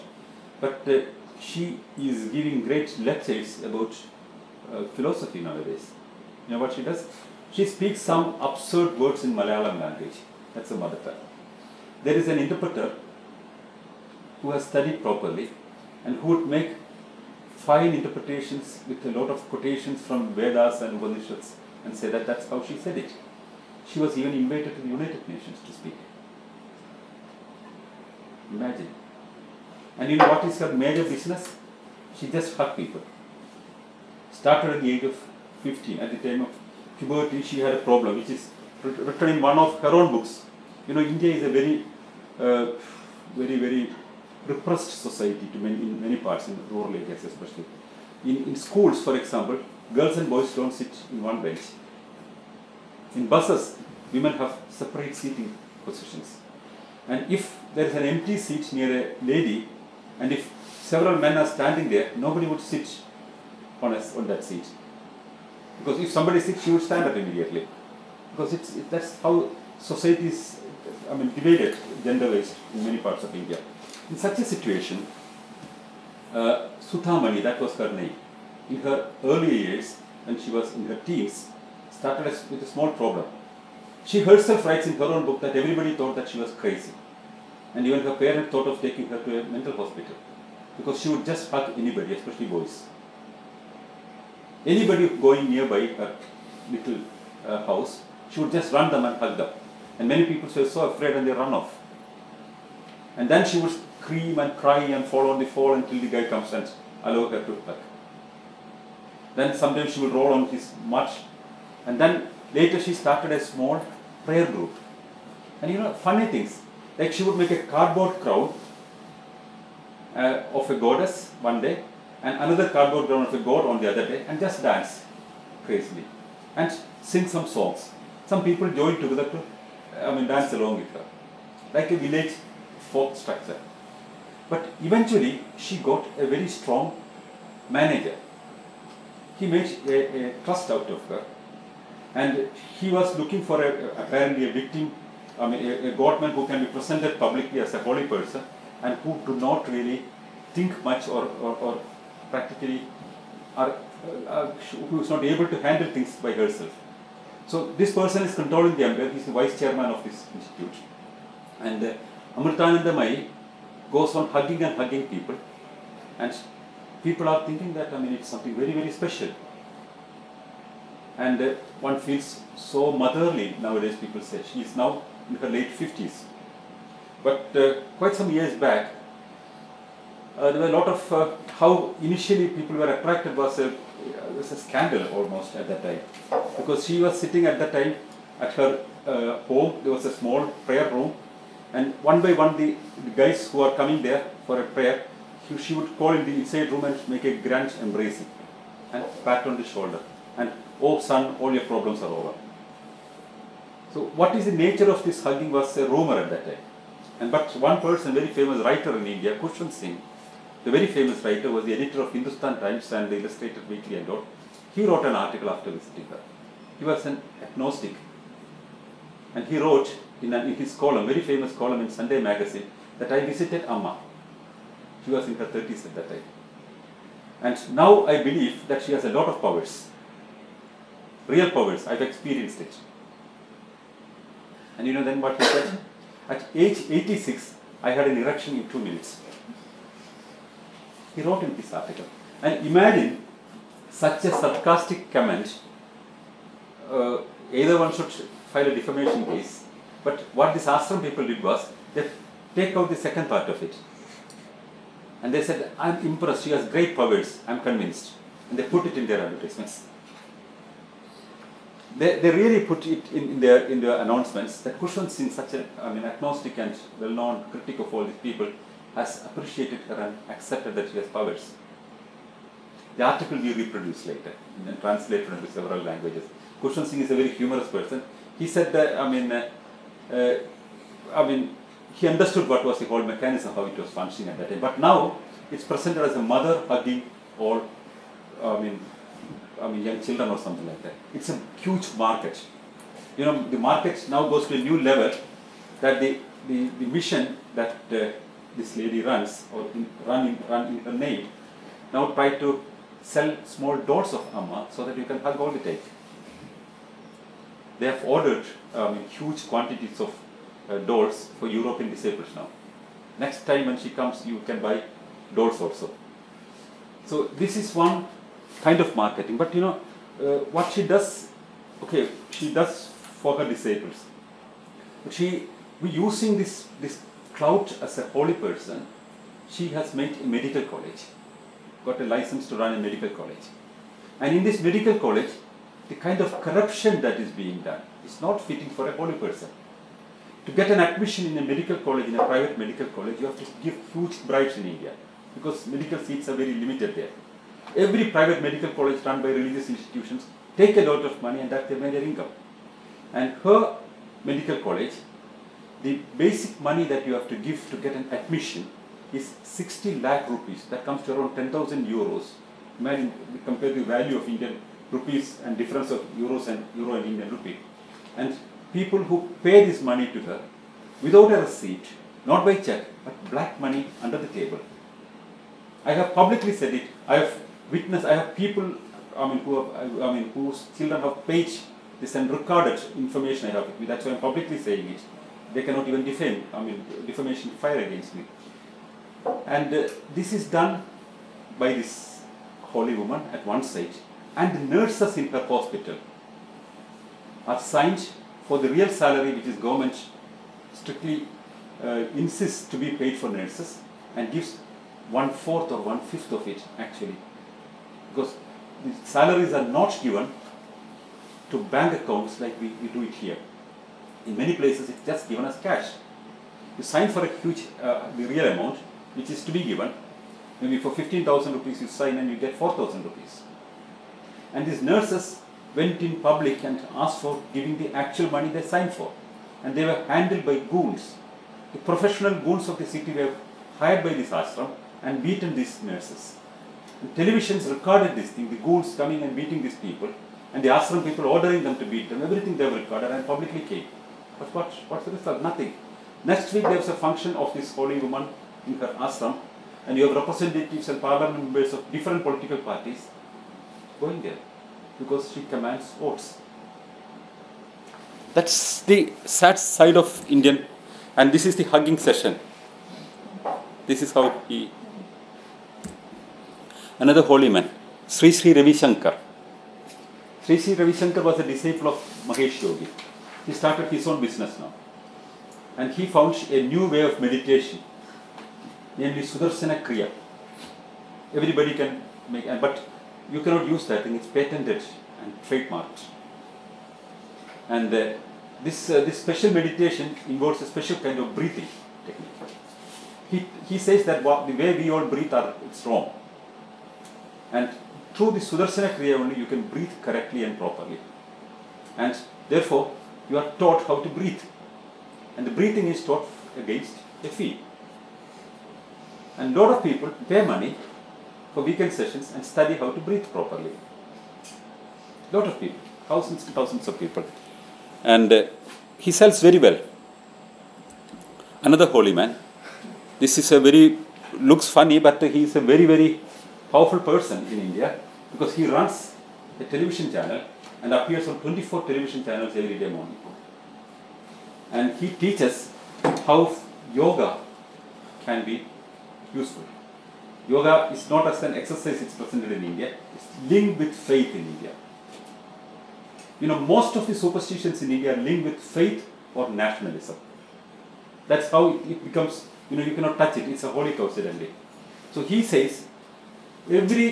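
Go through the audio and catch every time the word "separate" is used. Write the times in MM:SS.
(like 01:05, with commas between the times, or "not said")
00:54.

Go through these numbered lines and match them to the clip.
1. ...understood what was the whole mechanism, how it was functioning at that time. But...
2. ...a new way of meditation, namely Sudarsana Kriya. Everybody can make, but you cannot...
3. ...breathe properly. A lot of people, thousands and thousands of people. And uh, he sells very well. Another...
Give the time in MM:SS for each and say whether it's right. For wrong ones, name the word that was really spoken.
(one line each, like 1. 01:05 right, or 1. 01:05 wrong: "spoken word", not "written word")
1. 04:42 right
2. 07:56 right
3. 08:33 right.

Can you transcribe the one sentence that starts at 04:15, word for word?
And they said, I'm impressed, she has great powers, I'm convinced.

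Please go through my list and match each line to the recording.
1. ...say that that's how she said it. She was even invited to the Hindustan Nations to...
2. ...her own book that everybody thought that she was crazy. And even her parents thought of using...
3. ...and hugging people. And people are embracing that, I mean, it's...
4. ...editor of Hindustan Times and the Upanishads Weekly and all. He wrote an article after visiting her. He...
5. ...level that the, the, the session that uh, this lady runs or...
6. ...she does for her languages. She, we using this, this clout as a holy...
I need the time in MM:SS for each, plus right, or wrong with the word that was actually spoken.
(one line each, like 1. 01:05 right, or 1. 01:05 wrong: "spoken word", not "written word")
1. 00:21 wrong: "United", not "Hindustan"
2. 01:24 wrong: "taking", not "using"
3. 02:44 wrong: "thinking", not "embracing"
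4. 03:31 wrong: "Illustrated", not "Upanishads"
5. 04:54 wrong: "mission", not "session"
6. 05:22 wrong: "disciples", not "languages".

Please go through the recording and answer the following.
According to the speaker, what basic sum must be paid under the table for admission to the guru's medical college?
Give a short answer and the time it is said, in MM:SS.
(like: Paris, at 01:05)
60 lakh rupees, at 05:59.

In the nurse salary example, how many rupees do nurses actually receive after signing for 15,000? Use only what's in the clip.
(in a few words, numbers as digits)
4,000 rupees.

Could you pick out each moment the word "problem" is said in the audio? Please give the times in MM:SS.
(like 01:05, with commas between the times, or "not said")
00:37, 01:22, 03:21.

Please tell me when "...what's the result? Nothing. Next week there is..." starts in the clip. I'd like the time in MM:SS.
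07:24.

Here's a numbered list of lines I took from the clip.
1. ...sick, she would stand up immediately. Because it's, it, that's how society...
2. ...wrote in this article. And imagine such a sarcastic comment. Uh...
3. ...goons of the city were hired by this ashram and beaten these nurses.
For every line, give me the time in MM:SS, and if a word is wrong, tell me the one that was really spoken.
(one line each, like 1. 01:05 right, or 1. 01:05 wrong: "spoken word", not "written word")
1. 01:06 right
2. 04:01 right
3. 07:12 right.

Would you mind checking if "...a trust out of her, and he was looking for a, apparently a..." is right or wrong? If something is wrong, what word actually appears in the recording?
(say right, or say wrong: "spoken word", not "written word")
right.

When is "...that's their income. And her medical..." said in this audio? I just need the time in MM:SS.
05:51.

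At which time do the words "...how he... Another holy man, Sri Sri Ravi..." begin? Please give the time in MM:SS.
07:44.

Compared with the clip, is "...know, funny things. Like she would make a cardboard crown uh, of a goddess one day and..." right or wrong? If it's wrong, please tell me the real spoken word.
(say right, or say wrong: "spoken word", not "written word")
right.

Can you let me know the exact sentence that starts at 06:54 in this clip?
In many places, it's just given as cash.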